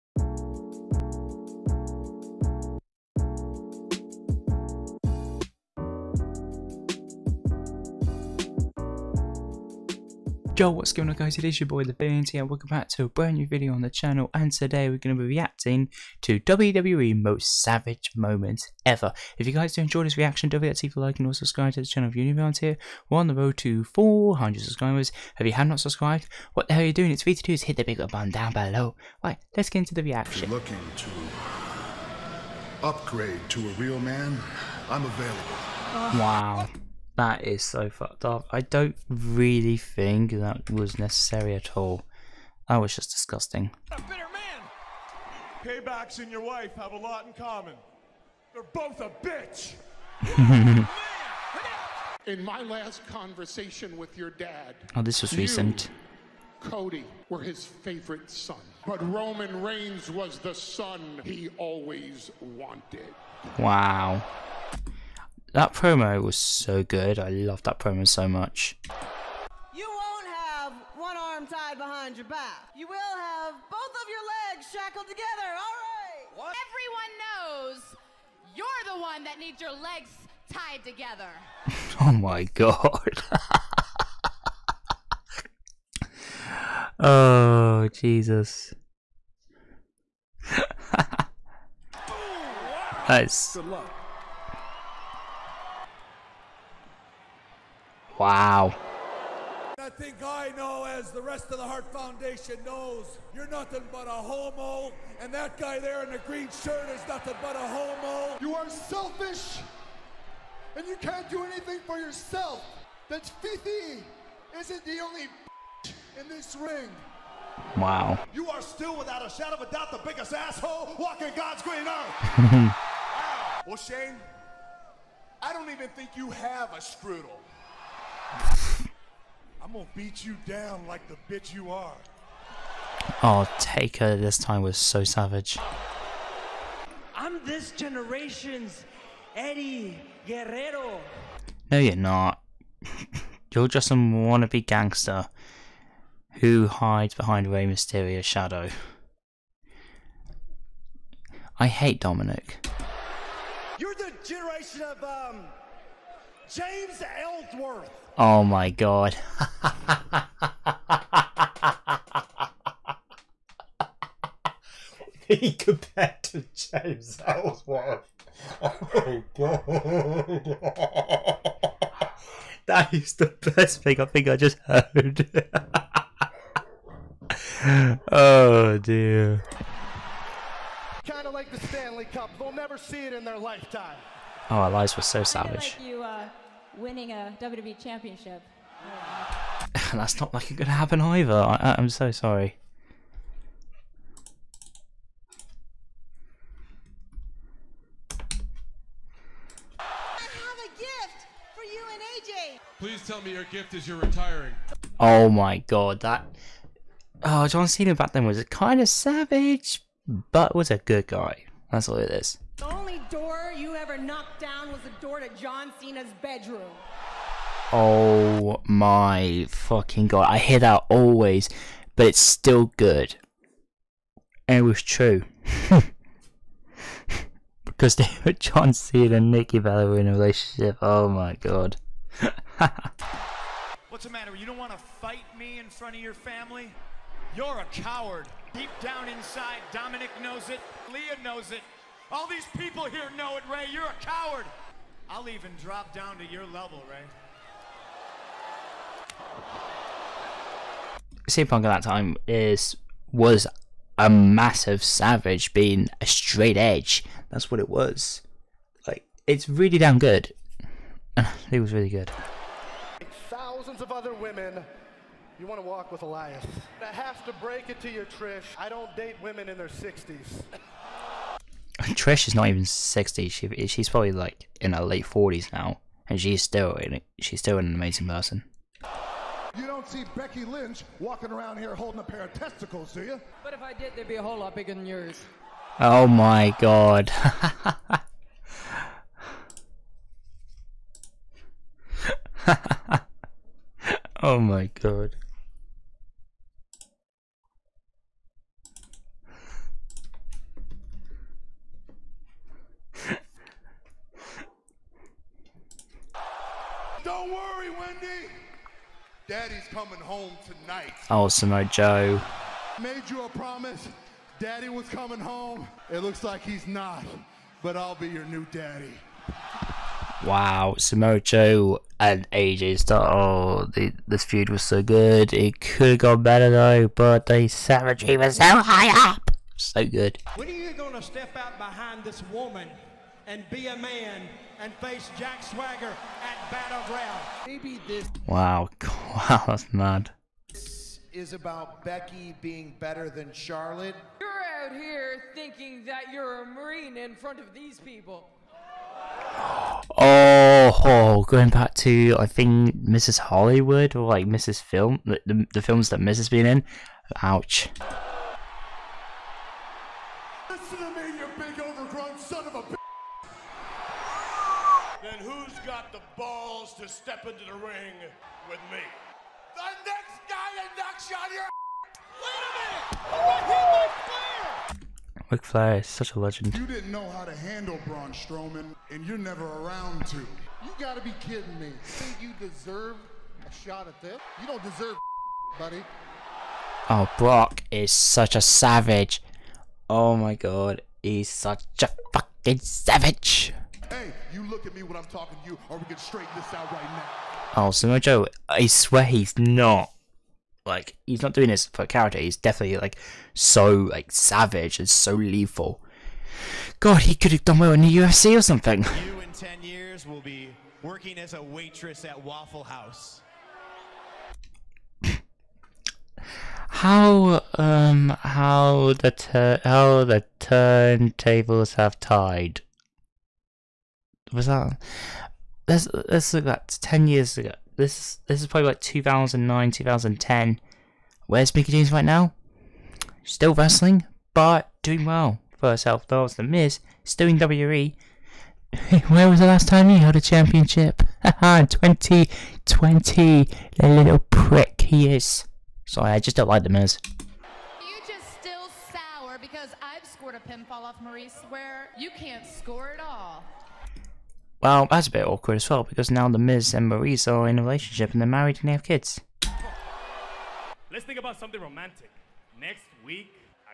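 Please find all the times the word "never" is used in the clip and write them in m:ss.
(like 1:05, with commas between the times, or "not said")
3:02, 6:19.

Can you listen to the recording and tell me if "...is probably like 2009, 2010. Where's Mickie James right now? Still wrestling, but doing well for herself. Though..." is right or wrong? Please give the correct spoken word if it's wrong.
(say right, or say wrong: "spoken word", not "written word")
right.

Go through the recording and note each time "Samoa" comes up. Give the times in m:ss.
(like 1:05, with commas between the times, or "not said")
5:11, 5:20, 6:37.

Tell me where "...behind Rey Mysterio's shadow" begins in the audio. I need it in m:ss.
2:27.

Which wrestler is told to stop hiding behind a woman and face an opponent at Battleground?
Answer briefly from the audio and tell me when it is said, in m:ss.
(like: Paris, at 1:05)
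Jack Swagger, at 5:35.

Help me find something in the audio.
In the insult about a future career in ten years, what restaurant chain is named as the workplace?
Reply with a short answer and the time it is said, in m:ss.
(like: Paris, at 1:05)
Waffle House, at 6:52.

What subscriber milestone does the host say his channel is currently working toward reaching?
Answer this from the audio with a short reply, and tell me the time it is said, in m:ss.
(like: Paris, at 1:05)
400, at 0:23.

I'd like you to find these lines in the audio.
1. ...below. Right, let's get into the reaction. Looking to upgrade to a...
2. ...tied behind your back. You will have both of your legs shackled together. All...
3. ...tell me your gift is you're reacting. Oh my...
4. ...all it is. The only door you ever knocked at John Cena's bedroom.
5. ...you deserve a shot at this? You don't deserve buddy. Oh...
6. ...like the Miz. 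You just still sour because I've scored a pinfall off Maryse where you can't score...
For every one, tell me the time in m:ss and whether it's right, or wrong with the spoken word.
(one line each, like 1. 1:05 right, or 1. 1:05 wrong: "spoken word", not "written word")
1. 0:28 right
2. 1:11 right
3. 3:23 wrong: "retiring", not "reacting"
4. 3:31 right
5. 6:22 right
6. 7:26 right.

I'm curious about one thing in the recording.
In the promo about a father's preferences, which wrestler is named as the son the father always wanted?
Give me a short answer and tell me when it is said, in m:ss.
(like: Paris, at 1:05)
Roman Reigns, at 0:59.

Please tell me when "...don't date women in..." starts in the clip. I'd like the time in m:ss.
4:28.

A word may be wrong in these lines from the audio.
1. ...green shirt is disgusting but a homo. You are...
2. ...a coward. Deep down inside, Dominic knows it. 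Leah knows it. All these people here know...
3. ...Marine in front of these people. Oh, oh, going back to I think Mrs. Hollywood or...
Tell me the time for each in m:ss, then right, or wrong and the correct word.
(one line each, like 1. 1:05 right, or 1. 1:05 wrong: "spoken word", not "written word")
1. 1:46 wrong: "nothing", not "disgusting"
2. 3:57 right
3. 5:46 right.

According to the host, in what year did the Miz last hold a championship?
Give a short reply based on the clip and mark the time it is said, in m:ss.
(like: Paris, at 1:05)
2020, at 7:21.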